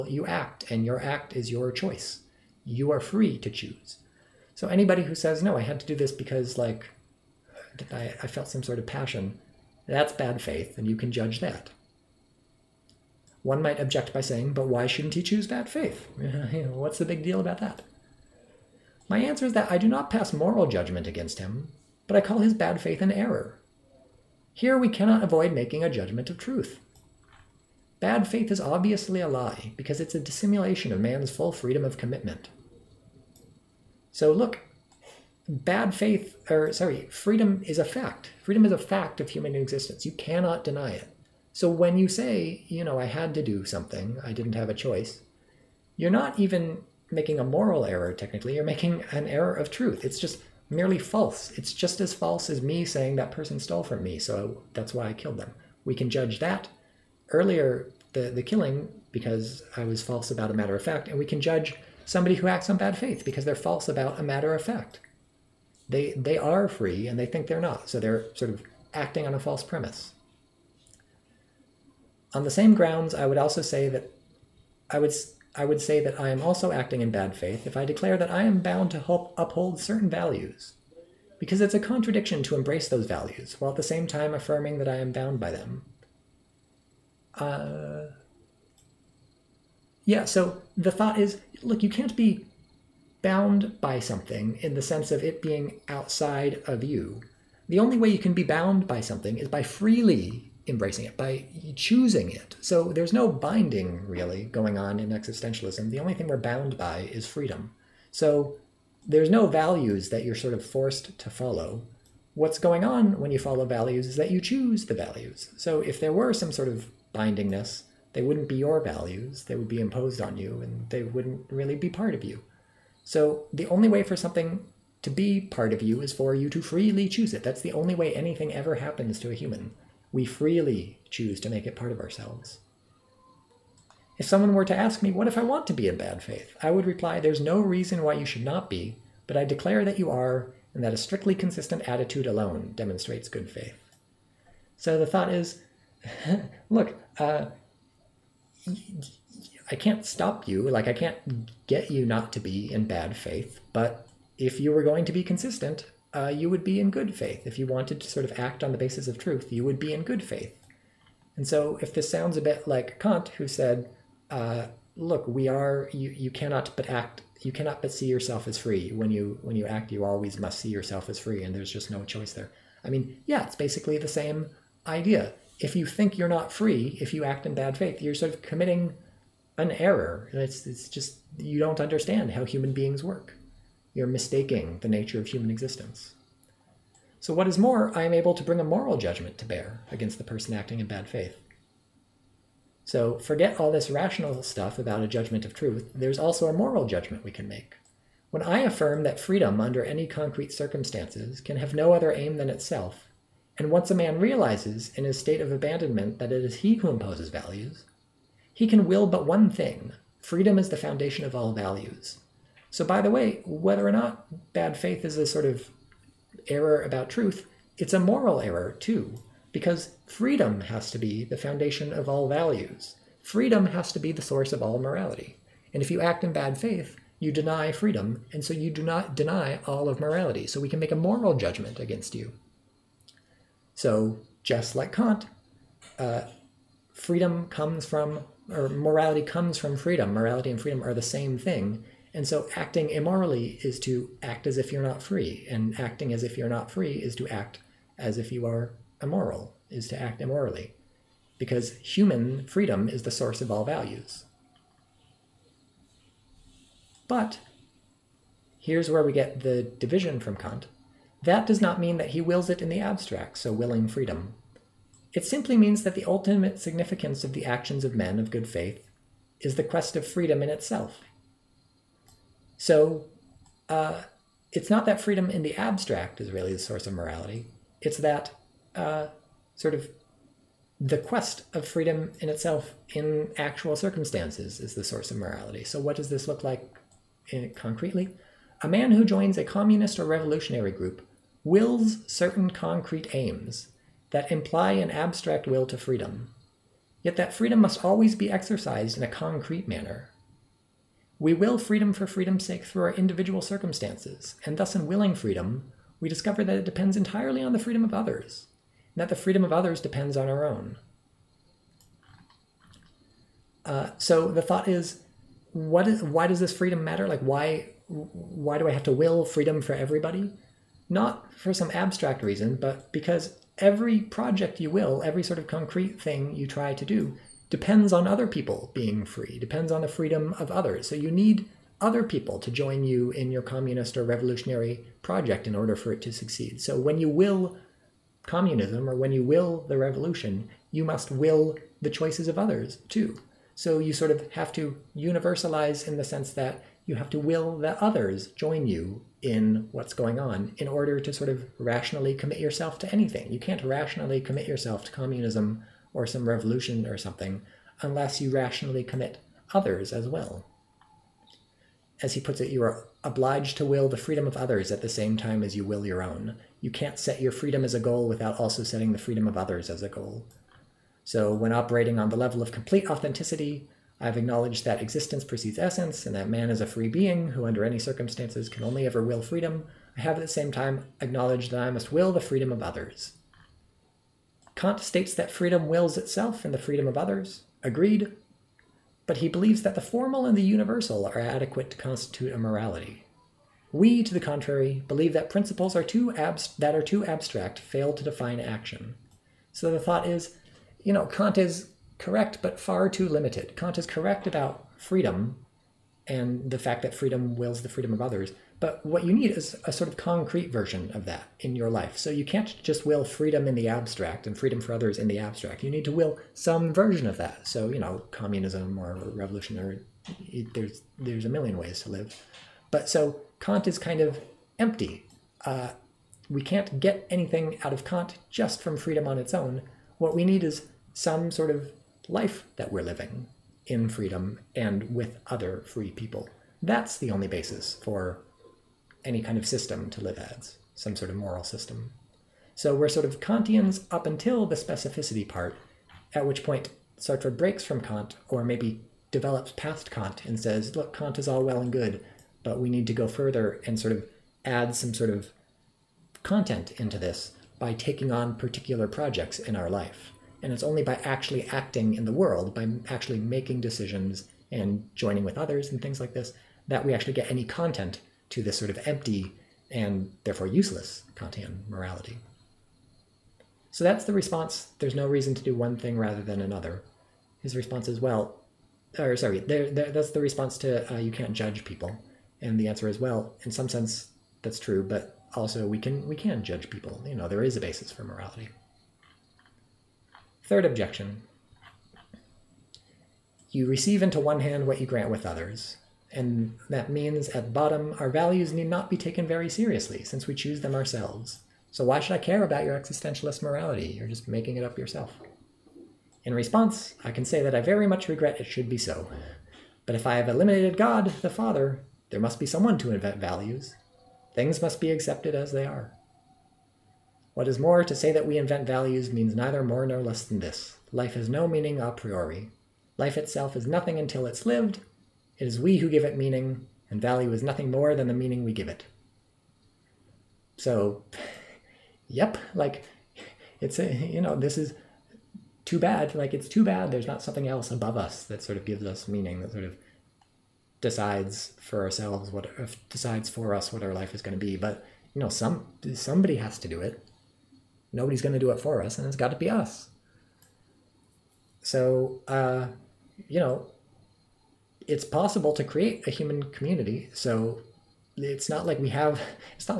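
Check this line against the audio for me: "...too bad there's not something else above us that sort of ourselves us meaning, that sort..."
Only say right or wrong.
wrong.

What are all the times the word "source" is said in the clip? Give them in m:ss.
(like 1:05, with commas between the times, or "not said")
3:44, 4:13, 4:36, 4:44.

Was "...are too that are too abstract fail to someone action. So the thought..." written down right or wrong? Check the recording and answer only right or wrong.
wrong.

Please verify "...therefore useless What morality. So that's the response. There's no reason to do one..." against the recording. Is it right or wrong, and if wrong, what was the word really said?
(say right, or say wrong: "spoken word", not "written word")
wrong: "Kantian", not "What".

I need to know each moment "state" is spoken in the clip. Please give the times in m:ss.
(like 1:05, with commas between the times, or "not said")
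3:25, 6:24.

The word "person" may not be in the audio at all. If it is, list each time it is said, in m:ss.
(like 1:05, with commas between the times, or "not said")
0:53, 3:10.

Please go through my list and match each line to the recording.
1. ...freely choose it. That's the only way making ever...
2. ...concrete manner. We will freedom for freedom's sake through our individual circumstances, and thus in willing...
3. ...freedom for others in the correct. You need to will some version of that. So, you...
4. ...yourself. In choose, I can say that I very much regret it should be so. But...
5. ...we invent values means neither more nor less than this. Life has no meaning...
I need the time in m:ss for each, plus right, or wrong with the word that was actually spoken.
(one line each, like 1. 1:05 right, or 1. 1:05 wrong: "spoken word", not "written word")
1. 2:06 wrong: "anything", not "making"
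2. 4:59 right
3. 6:54 wrong: "abstract", not "correct"
4. 8:24 wrong: "response", not "choose"
5. 8:38 right.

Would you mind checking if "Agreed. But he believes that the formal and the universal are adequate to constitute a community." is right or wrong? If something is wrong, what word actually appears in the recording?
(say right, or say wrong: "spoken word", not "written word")
wrong: "morality", not "community".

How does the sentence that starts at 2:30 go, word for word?
Like, I can't get you not to be in bad faith.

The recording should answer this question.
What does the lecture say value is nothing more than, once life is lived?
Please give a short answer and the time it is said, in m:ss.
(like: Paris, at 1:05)
The meaning we give it, at 8:48.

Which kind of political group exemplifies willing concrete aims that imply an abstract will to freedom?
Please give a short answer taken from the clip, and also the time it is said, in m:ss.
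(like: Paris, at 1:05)
Communist or revolutionary group, at 4:49.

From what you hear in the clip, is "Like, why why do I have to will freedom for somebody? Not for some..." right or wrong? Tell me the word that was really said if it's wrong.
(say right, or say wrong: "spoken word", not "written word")
wrong: "everybody", not "somebody".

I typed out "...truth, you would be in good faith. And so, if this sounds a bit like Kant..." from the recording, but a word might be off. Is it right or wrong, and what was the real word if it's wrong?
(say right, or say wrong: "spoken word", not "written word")
right.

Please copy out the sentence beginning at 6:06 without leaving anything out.
You can't set your freedom as a goal without also setting the freedom of others as a goal.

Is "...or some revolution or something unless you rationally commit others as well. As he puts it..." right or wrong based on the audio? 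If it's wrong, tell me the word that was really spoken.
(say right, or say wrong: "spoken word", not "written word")
right.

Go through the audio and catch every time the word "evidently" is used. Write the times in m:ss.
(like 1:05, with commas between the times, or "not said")
not said.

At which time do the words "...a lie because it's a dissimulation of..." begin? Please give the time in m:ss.
0:29.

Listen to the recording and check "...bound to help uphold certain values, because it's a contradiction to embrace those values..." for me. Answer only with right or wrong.
right.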